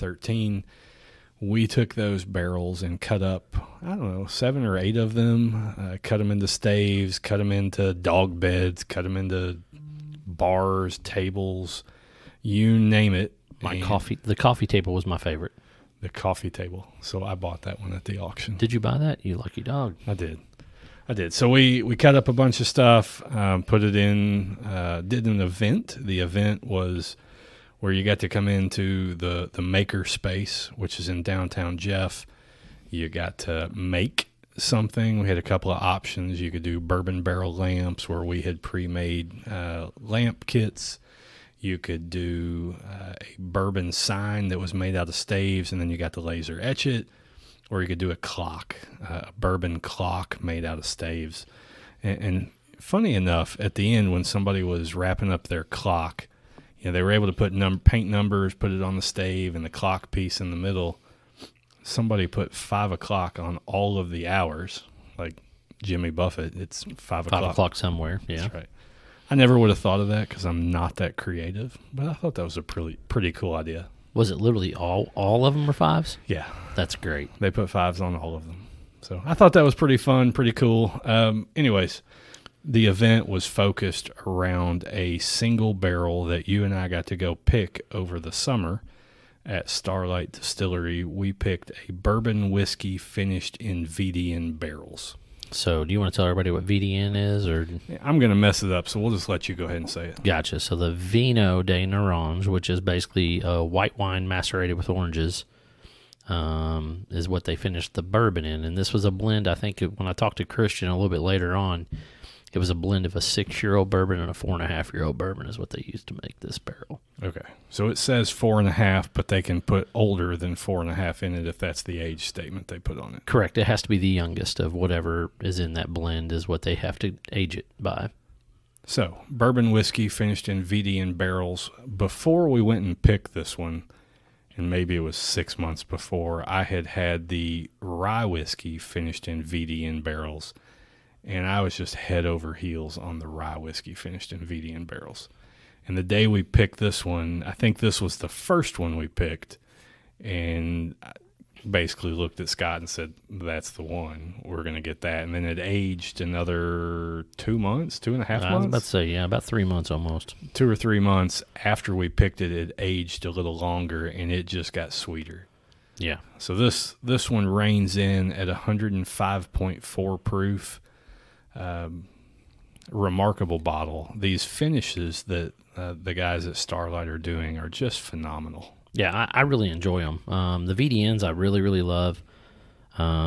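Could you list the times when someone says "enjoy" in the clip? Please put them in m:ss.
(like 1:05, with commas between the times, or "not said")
2:59.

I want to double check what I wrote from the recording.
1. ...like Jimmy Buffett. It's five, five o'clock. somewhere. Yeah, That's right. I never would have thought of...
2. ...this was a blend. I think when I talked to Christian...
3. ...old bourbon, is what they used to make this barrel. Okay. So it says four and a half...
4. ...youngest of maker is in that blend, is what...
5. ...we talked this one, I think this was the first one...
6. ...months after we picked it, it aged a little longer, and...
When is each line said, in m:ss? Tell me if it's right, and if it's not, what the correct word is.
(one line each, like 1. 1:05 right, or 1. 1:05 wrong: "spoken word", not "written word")
1. 1:05 right
2. 1:48 right
3. 1:55 right
4. 2:04 wrong: "whatever", not "maker"
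5. 2:26 wrong: "picked", not "talked"
6. 2:41 right.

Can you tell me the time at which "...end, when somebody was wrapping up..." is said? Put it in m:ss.
0:53.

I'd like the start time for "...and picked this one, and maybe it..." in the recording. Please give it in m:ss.
2:12.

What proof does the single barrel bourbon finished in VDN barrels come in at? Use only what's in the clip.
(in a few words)
105.4.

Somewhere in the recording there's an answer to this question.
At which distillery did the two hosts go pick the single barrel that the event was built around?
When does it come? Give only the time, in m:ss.
1:29.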